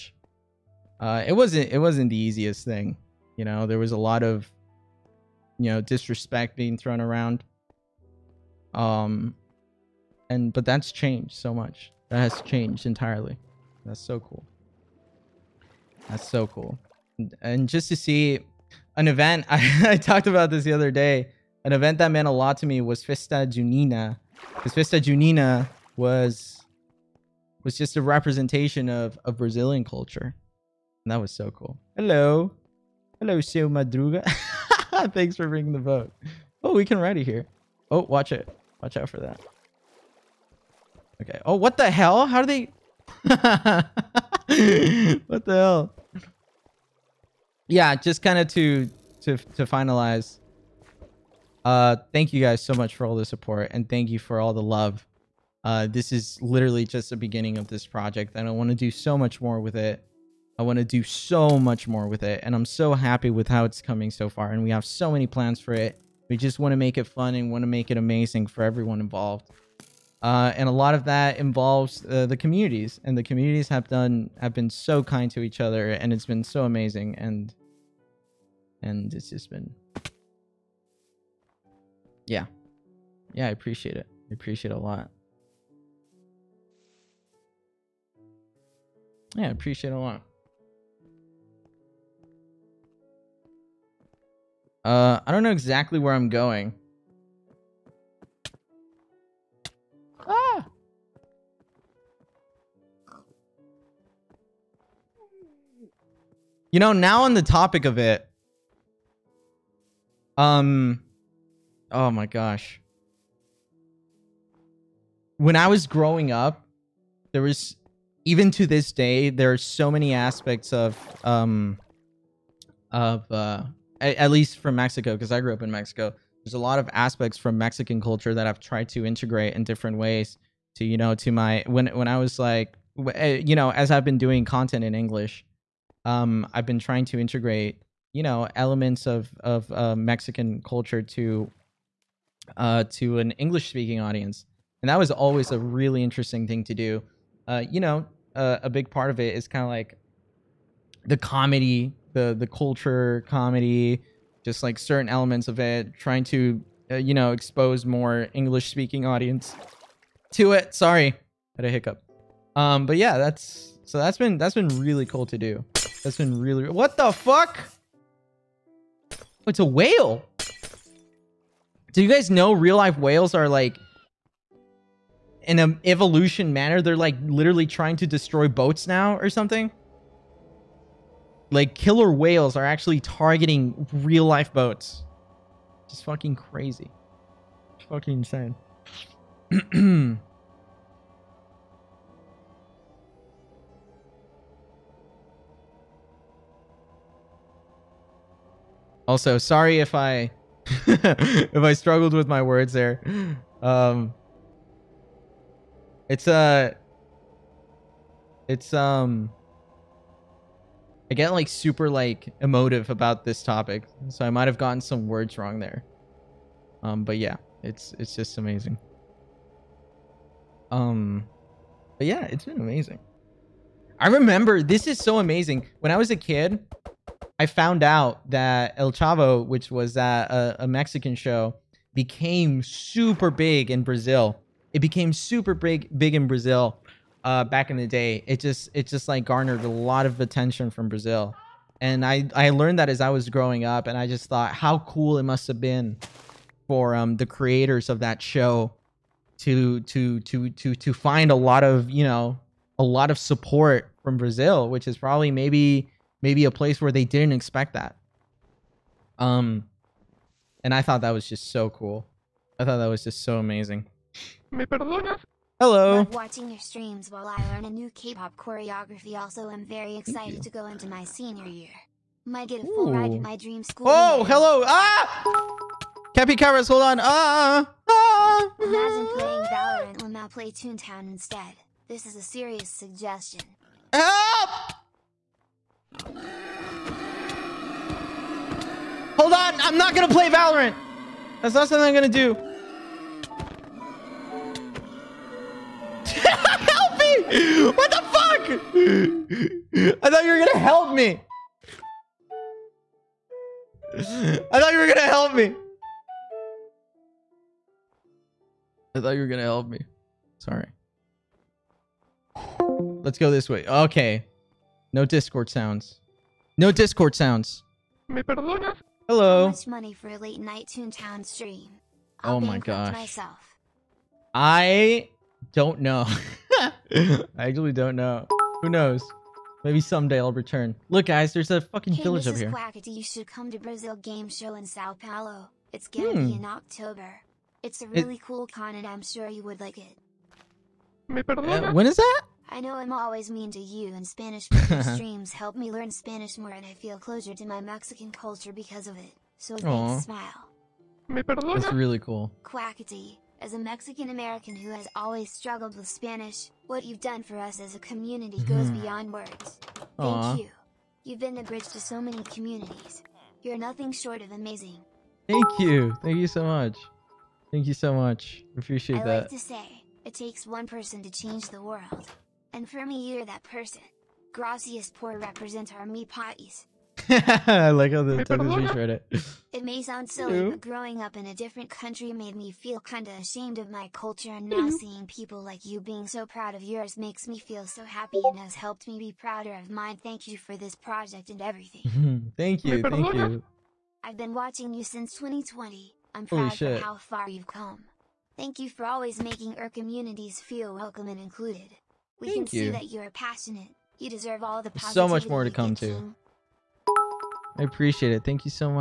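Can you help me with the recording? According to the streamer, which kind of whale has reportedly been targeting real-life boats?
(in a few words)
Killer whales.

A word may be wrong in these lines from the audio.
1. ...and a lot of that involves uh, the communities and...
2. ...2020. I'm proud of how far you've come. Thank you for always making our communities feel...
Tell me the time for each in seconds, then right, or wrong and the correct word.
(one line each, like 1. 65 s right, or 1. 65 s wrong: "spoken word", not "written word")
1. 70 s right
2. 395 s right.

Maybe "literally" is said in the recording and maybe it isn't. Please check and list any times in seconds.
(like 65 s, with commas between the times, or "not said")
56 s, 177 s.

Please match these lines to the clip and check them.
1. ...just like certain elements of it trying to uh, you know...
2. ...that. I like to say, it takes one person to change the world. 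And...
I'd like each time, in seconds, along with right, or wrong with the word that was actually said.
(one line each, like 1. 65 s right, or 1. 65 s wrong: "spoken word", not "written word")
1. 154 s right
2. 369 s right.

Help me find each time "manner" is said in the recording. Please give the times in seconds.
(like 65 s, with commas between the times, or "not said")
176 s.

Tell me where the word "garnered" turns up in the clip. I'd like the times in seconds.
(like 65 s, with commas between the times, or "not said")
239 s.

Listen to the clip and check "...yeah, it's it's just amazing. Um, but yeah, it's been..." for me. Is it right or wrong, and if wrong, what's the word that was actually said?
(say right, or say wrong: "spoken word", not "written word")
right.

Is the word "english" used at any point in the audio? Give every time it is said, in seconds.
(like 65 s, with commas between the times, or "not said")
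134 s, 143 s, 158 s.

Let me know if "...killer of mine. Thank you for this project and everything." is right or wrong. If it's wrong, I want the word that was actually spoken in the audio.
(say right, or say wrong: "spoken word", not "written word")
wrong: "prouder", not "killer".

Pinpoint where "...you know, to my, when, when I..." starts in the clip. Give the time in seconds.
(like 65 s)
130 s.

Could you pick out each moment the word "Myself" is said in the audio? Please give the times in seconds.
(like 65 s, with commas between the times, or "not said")
322 s.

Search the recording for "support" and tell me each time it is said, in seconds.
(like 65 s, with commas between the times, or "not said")
53 s, 253 s.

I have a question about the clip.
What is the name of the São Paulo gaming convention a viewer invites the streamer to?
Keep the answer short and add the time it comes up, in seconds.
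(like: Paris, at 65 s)
Brazil Game Show, at 333 s.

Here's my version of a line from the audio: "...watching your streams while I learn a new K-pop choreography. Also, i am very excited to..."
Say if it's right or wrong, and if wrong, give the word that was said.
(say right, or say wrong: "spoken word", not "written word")
right.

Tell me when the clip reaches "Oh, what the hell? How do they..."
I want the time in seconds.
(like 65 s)
41 s.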